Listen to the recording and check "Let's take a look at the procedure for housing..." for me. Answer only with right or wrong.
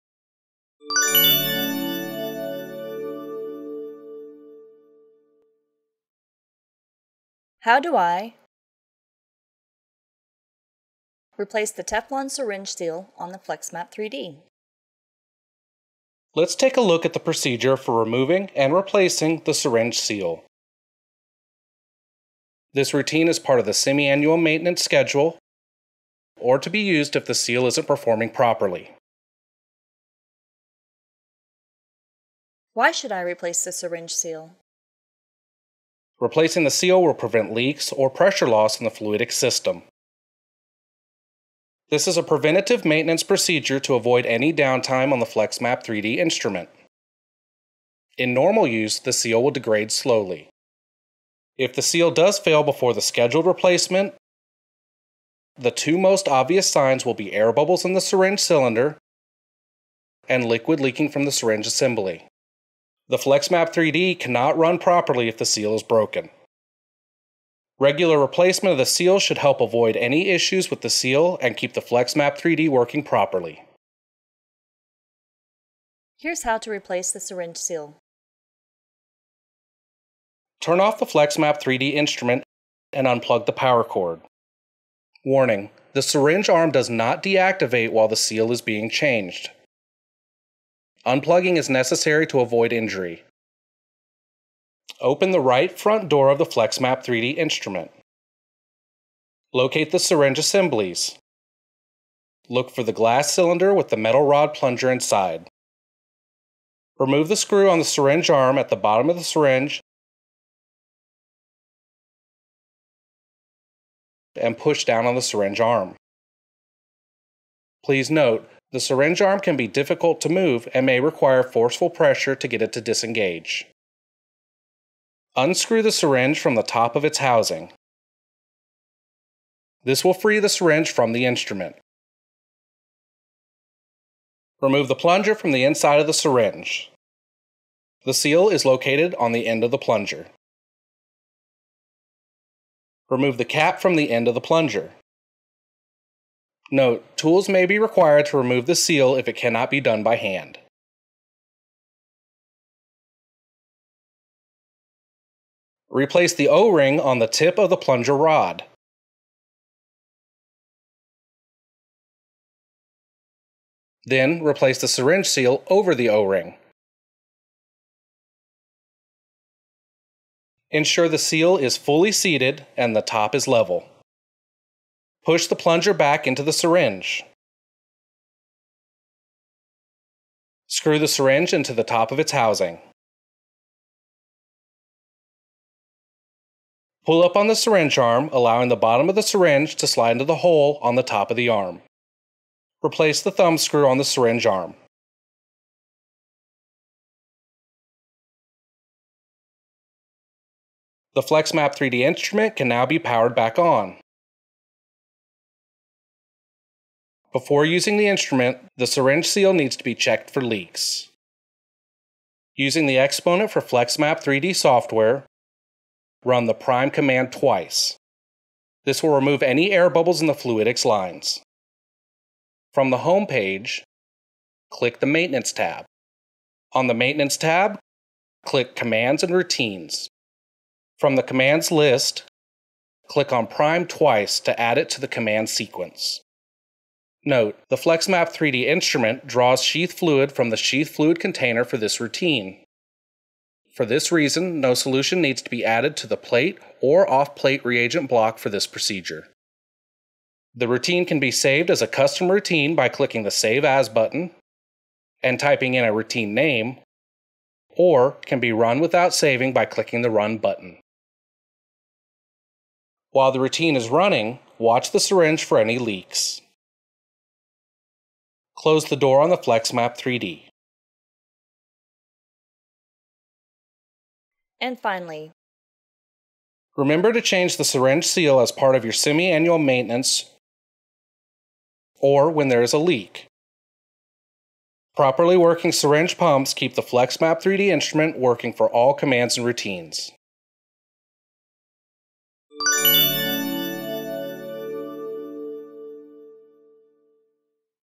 wrong.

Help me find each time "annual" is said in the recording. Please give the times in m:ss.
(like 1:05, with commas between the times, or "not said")
0:23, 4:38.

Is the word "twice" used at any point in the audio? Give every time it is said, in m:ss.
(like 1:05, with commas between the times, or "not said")
3:37, 3:53.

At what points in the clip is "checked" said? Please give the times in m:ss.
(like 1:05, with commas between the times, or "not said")
3:29.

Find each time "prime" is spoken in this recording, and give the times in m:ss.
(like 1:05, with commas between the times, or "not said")
3:36, 3:53.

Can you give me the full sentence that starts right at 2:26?
Note, tools may be required to remove the seal if it cannot be done by hand.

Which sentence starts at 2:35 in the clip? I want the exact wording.
Replace the O-ring on the tip of the plunger rod.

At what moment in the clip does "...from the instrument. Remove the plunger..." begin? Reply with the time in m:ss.
2:10.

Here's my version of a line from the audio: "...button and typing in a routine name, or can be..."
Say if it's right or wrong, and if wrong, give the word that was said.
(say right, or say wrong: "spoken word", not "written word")
right.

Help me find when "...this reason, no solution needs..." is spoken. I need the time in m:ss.
4:03.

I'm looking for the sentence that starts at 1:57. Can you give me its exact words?
Please note, the syringe arm can be difficult to move and may require forceful pressure to get it to disengage.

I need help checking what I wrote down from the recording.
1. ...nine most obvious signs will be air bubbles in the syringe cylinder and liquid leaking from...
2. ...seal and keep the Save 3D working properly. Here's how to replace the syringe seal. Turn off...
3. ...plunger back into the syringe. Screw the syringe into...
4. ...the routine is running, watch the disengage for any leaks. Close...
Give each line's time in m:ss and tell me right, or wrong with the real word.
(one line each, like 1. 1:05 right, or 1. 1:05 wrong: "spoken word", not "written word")
1. 0:55 wrong: "two", not "nine"
2. 1:10 wrong: "FlexMap", not "Save"
3. 2:55 right
4. 4:23 wrong: "syringe", not "disengage".